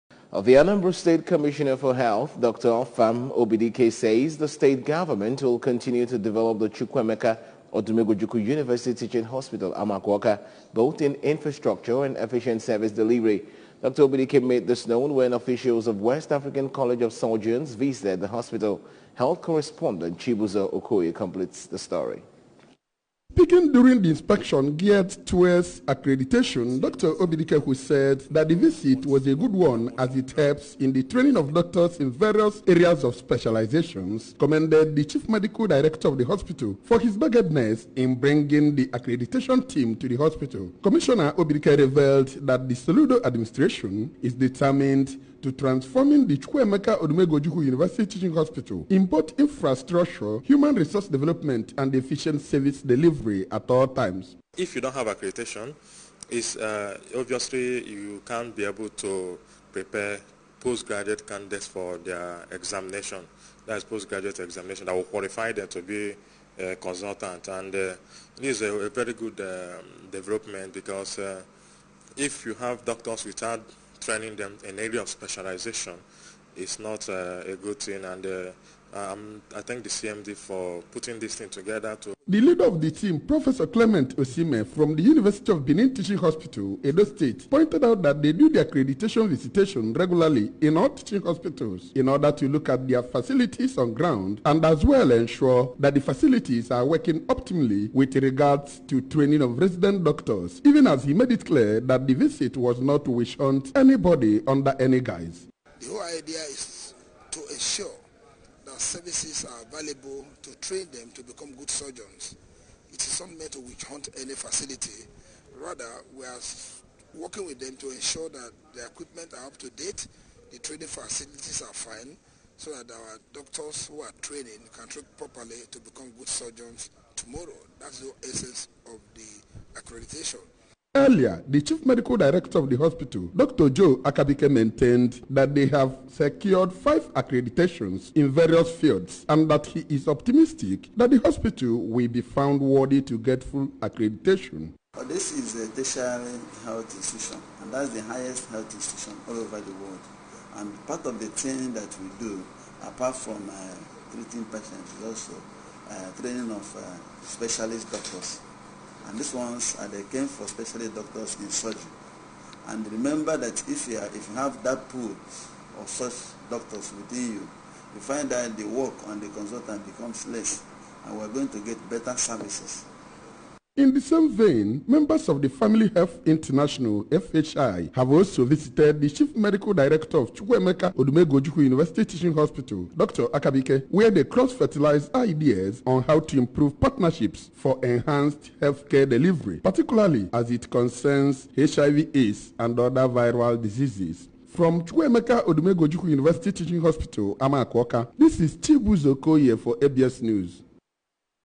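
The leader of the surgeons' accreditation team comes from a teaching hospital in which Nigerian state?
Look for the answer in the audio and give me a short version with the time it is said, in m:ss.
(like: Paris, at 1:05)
Edo State, at 1:26.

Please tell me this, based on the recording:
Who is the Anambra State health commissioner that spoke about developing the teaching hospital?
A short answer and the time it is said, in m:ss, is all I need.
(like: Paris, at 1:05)
Dr. Afam Obidike, at 0:02.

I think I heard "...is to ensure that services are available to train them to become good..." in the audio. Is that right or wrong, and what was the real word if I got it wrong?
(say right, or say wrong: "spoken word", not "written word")
right.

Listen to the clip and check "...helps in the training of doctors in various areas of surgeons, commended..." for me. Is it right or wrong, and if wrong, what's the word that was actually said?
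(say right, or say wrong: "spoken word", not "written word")
wrong: "specializations", not "surgeons".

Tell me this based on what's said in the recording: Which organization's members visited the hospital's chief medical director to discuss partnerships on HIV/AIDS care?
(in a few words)
Family Health International.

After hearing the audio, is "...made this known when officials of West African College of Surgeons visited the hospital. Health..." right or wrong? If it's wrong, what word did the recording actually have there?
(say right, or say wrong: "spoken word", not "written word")
right.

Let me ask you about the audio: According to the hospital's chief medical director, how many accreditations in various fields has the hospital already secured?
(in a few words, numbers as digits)
5.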